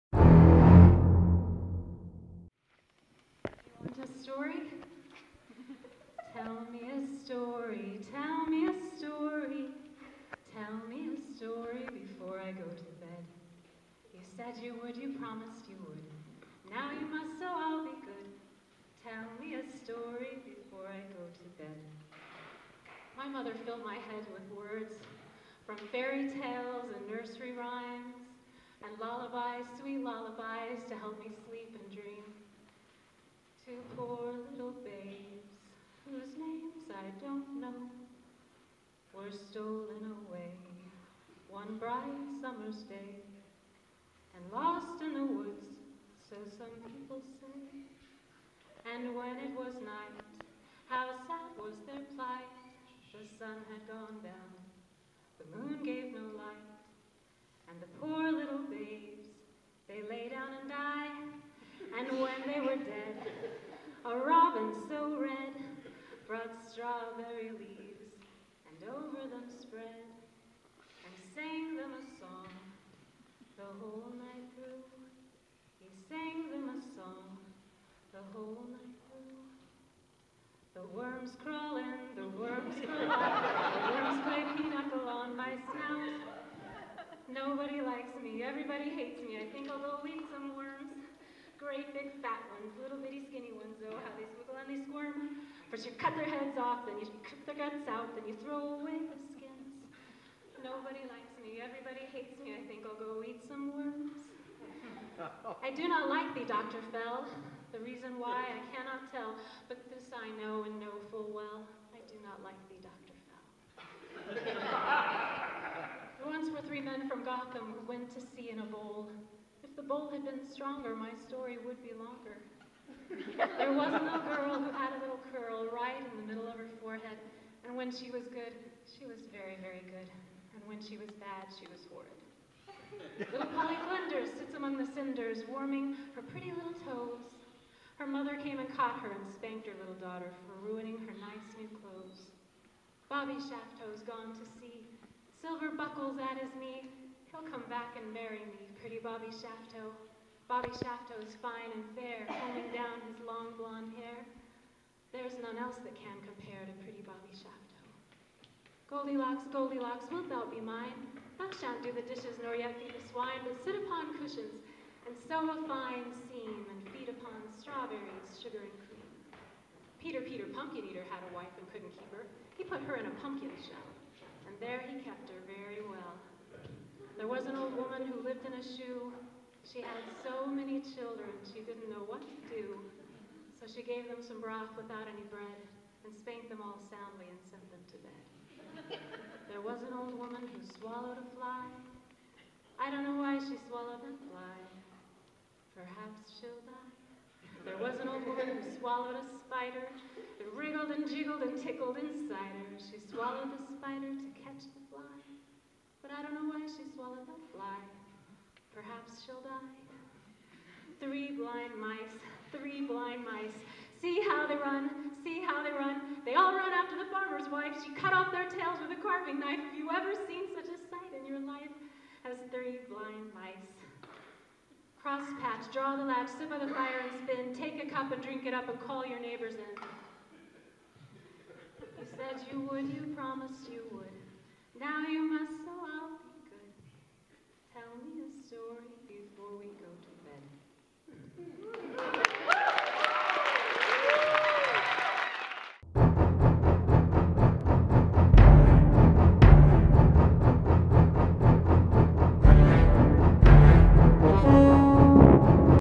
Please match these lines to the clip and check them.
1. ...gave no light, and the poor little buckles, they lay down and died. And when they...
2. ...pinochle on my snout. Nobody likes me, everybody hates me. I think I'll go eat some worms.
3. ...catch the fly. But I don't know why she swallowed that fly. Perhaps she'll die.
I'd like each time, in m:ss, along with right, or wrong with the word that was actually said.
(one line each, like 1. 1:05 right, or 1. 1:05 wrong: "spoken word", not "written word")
1. 0:55 wrong: "babes", not "buckles"
2. 1:24 right
3. 3:24 right.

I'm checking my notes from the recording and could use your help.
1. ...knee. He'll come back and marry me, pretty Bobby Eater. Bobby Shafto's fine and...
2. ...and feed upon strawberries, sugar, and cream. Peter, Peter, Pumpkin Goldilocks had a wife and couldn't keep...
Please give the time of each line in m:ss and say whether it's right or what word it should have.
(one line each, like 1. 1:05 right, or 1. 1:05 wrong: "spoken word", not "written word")
1. 2:26 wrong: "Shafto", not "Eater"
2. 2:46 wrong: "Eater", not "Goldilocks".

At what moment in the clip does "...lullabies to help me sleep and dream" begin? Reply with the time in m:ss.
0:30.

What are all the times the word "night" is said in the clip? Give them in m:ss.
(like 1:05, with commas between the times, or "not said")
0:49, 1:14, 1:18.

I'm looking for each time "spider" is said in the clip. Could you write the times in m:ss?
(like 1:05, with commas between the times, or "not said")
3:19, 3:23.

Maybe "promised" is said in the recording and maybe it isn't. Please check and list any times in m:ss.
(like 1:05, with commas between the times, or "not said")
0:15, 3:53.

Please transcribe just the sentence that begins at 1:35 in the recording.
First you cut their heads off, then you cut their guts out, then you throw away the Nobody likes me.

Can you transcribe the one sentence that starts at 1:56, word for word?
Once were three men from Gotham who went to sea in a bowl.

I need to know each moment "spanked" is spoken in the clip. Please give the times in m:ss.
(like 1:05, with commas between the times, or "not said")
2:19, 3:06.